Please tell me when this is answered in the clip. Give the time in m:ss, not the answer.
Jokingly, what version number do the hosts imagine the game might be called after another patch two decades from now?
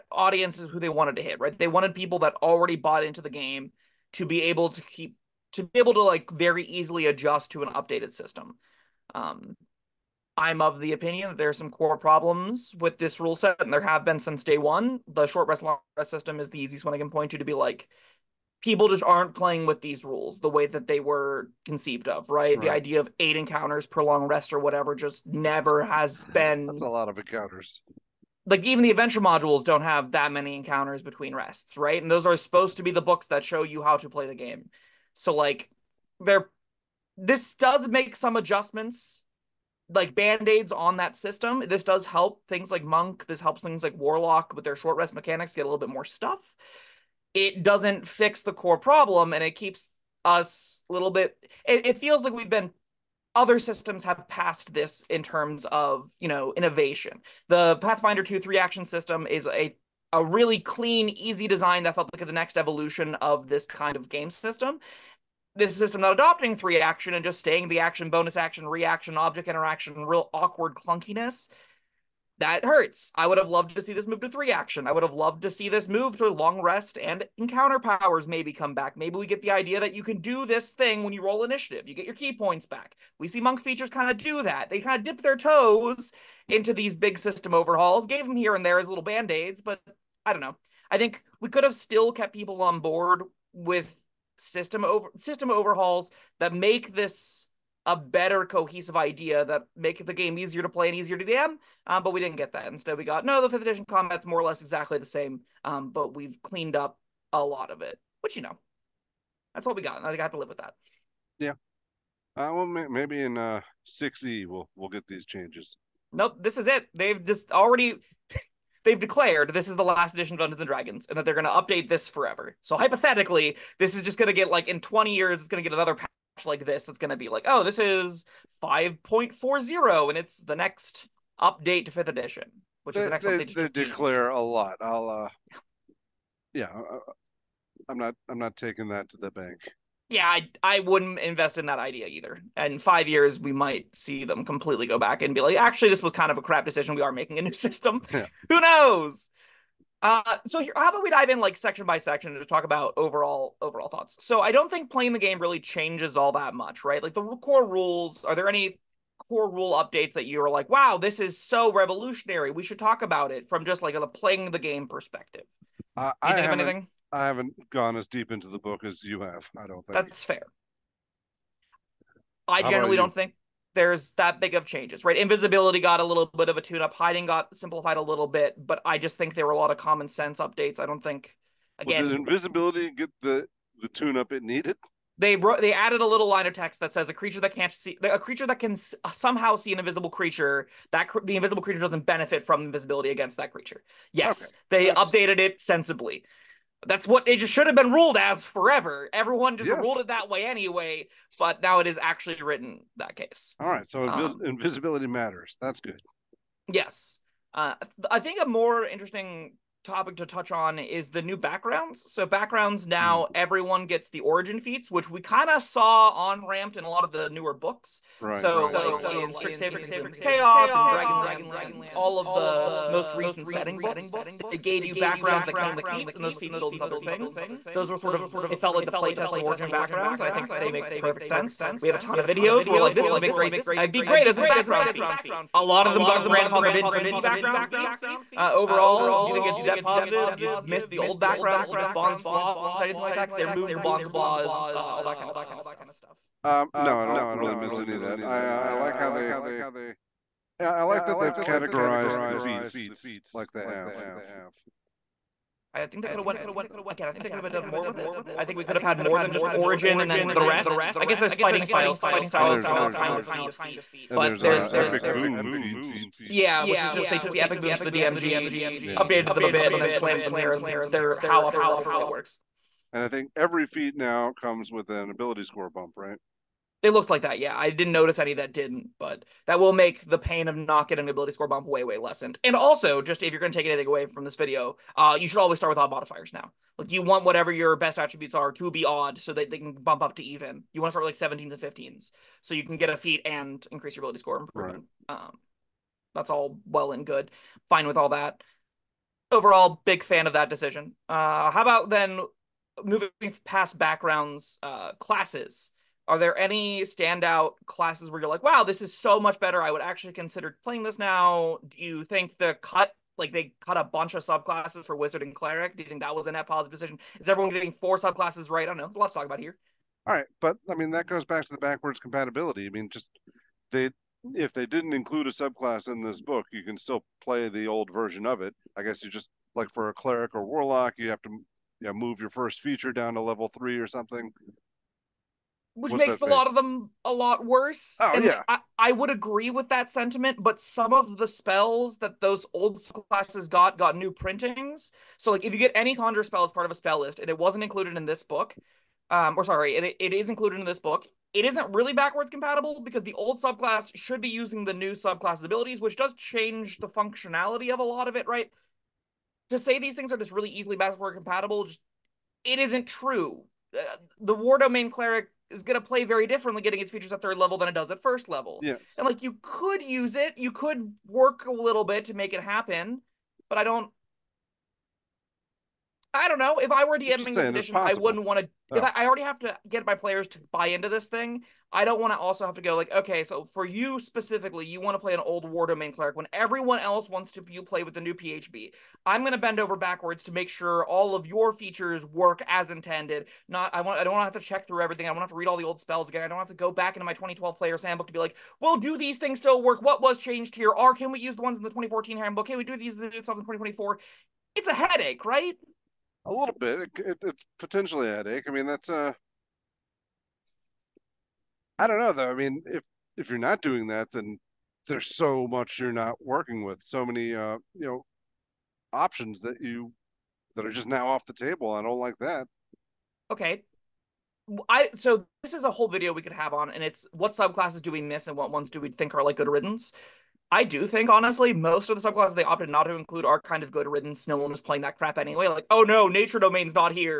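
2:08.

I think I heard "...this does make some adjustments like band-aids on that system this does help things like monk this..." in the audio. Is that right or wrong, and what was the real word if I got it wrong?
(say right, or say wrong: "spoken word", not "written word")
right.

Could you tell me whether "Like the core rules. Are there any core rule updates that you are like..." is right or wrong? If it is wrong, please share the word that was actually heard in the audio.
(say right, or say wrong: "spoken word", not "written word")
right.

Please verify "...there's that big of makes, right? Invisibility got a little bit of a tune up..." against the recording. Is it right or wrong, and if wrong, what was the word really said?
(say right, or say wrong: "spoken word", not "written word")
wrong: "changes", not "makes".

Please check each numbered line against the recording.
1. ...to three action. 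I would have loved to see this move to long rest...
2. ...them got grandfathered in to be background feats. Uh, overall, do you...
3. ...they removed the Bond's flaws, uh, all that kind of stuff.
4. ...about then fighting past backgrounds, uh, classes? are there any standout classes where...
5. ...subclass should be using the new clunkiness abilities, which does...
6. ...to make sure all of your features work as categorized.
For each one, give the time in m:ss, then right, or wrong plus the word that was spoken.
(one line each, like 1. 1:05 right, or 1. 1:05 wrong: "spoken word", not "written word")
1. 1:14 right
2. 3:55 right
3. 4:03 right
4. 5:01 wrong: "moving", not "fighting"
5. 5:53 wrong: "subclass", not "clunkiness"
6. 6:30 wrong: "intended", not "categorized".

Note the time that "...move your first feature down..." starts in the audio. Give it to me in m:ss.
5:31.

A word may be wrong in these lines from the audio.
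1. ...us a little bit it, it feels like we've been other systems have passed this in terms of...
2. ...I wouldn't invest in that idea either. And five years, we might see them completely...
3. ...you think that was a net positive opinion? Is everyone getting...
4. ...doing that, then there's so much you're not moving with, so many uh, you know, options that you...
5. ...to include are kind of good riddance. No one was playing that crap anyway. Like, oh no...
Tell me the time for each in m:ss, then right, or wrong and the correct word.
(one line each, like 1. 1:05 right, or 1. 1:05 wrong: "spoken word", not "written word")
1. 0:50 right
2. 2:20 right
3. 5:15 wrong: "decision", not "opinion"
4. 6:53 wrong: "working", not "moving"
5. 7:12 right.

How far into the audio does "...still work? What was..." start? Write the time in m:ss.
6:39.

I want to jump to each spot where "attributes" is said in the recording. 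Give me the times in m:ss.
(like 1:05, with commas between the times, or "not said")
4:47.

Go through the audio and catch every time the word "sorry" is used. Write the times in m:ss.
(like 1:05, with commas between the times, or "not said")
5:49.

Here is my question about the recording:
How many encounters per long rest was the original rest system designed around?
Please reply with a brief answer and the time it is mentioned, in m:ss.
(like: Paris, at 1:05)
8, at 0:23.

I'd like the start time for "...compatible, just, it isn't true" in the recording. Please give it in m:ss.
6:01.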